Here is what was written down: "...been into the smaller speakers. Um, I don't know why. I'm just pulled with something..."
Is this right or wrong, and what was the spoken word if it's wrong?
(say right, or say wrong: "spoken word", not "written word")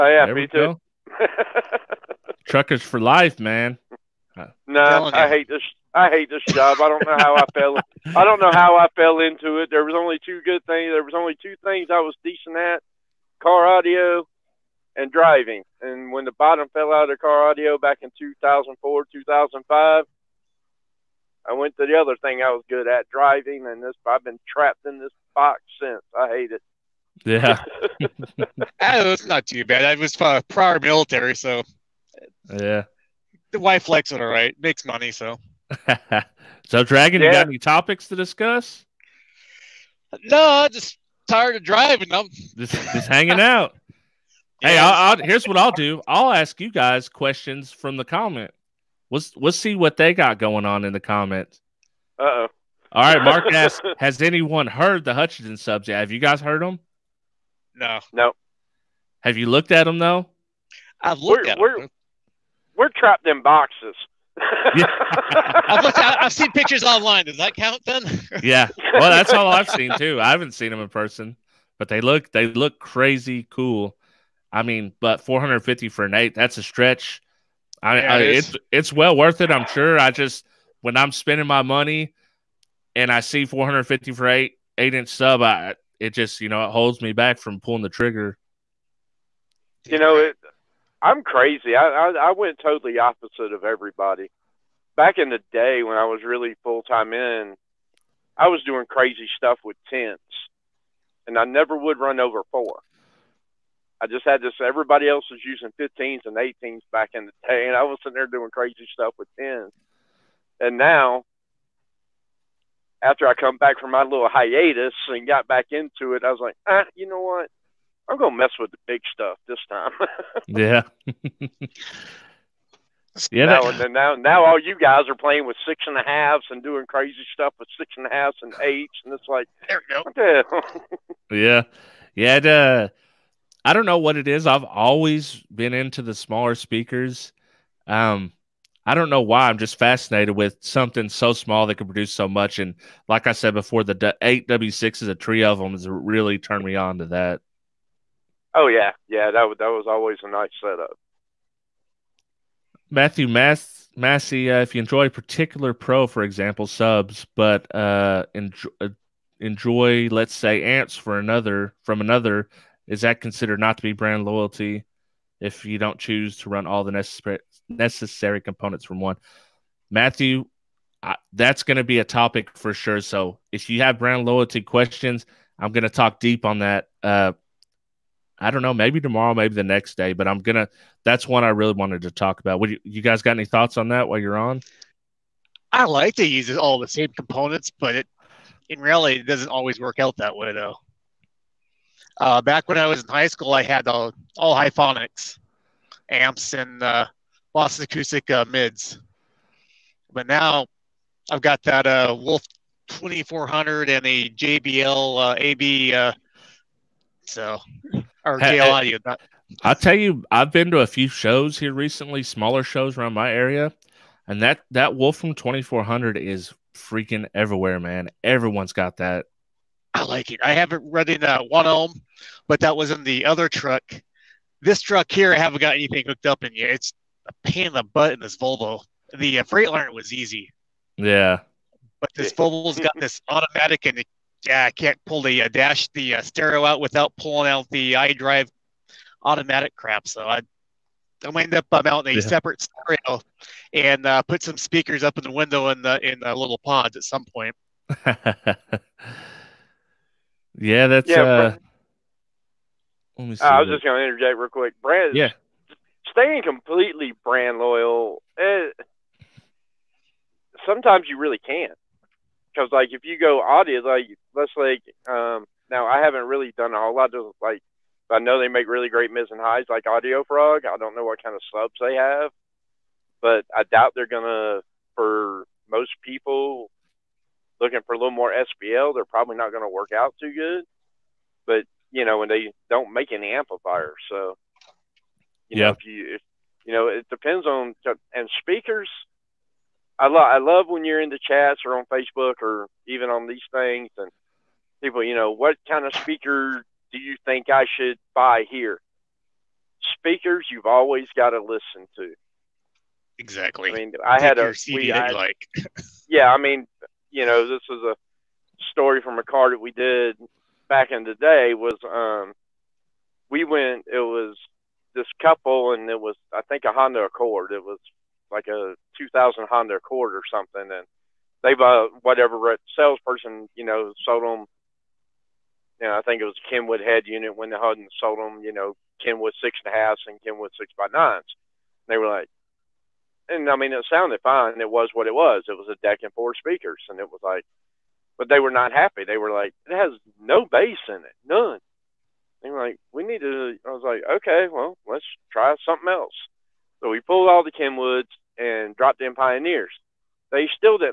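wrong: "fascinated", not "pulled".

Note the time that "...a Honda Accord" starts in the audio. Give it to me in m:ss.
5:16.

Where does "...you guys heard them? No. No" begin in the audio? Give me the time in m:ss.
0:56.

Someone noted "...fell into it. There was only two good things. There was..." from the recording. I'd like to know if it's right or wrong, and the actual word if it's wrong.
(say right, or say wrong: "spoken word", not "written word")
right.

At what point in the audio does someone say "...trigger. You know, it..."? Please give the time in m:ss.
1:27.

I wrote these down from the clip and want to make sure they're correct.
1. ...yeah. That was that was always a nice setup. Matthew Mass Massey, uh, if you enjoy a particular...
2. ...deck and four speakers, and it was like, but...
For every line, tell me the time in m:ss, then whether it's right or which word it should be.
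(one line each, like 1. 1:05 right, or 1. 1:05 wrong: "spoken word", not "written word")
1. 2:29 right
2. 5:35 right.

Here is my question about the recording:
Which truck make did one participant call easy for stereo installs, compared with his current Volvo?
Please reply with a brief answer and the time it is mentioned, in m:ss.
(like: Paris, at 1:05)
Freightliner, at 3:49.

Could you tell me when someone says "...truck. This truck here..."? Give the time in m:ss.
3:43.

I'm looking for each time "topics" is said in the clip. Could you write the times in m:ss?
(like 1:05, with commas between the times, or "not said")
0:37, 2:52.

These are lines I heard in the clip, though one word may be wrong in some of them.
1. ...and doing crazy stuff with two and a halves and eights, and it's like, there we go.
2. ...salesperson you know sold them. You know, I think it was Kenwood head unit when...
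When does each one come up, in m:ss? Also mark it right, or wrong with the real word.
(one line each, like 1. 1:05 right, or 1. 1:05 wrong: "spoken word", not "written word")
1. 2:06 wrong: "six", not "two"
2. 5:22 right.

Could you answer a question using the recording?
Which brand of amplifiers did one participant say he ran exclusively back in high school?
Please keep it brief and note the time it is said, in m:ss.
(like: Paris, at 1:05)
Hifonics, at 3:14.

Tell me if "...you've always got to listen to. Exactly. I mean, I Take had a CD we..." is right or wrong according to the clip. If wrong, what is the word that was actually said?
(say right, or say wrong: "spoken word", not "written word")
right.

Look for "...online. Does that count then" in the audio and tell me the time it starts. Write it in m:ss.
1:06.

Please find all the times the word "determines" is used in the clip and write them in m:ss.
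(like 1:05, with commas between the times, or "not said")
not said.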